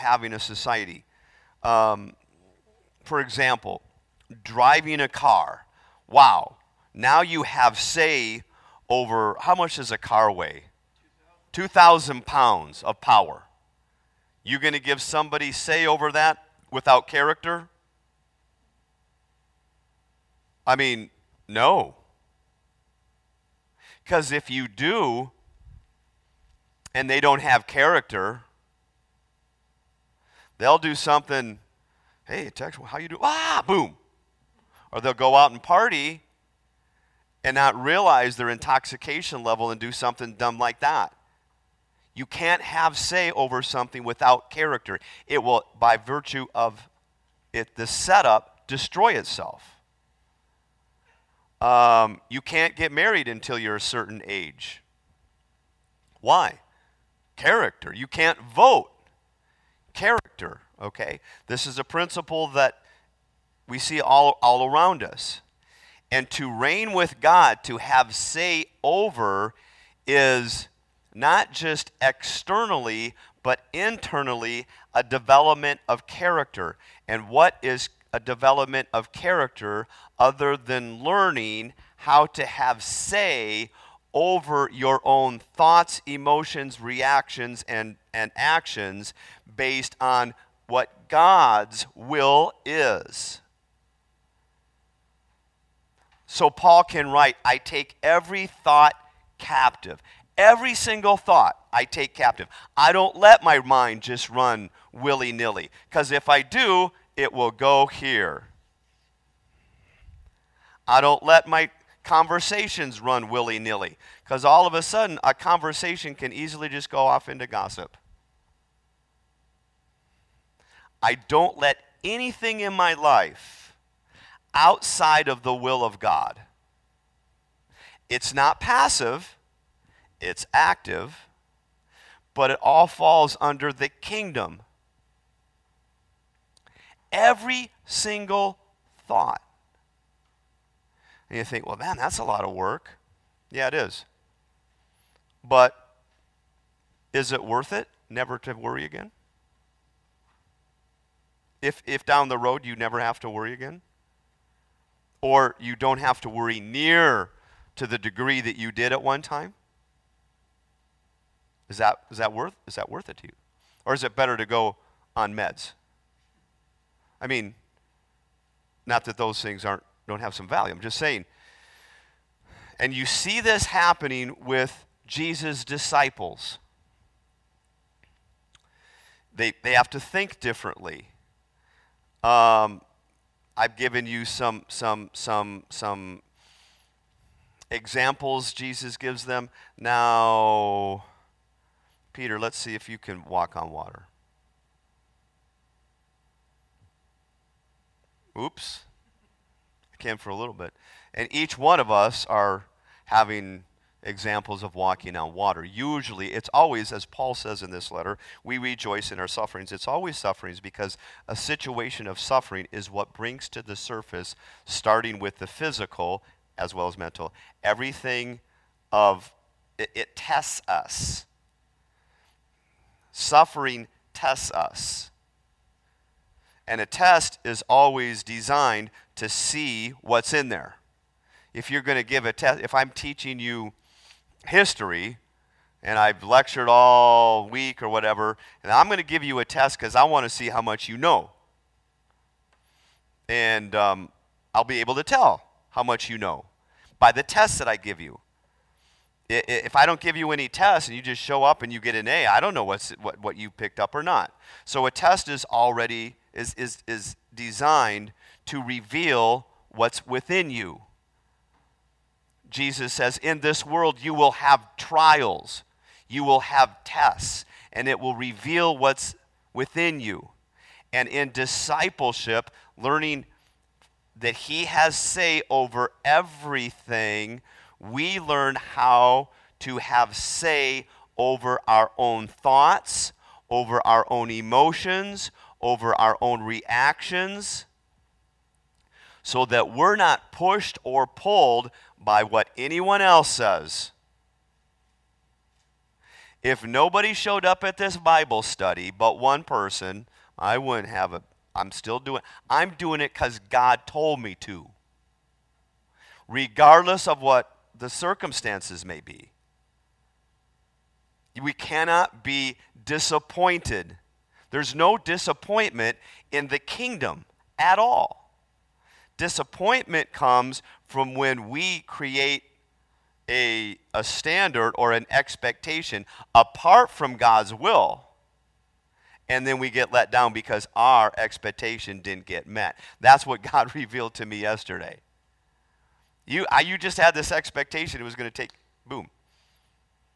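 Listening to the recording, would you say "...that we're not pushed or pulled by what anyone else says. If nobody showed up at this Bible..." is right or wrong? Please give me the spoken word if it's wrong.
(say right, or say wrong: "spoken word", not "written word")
right.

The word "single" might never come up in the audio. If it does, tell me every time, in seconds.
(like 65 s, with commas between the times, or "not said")
100 s, 137 s.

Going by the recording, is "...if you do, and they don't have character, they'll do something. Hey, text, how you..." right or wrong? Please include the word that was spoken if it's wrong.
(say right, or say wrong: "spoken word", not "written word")
right.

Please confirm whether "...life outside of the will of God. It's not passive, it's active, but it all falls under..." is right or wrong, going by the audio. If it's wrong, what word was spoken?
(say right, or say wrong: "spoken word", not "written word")
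right.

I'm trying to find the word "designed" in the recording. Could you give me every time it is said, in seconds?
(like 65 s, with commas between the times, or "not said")
228 s, 257 s.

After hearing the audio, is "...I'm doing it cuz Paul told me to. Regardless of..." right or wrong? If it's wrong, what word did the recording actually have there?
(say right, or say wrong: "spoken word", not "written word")
wrong: "God", not "Paul".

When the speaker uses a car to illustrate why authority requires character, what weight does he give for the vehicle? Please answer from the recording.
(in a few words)
2,000 pounds.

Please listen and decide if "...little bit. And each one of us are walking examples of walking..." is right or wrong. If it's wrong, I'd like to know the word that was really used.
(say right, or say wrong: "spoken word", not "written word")
wrong: "having", not "walking".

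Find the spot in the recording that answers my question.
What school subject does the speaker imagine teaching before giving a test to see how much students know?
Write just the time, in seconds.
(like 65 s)
234 s.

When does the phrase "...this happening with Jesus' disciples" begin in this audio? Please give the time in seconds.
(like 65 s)
173 s.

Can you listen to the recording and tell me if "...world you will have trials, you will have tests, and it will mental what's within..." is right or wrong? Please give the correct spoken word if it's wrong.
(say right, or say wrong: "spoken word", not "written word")
wrong: "reveal", not "mental".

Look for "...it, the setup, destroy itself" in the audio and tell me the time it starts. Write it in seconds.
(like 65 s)
47 s.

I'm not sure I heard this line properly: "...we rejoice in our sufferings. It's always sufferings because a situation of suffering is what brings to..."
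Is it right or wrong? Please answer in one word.
right.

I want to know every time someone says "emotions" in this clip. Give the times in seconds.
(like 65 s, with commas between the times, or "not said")
86 s, 284 s.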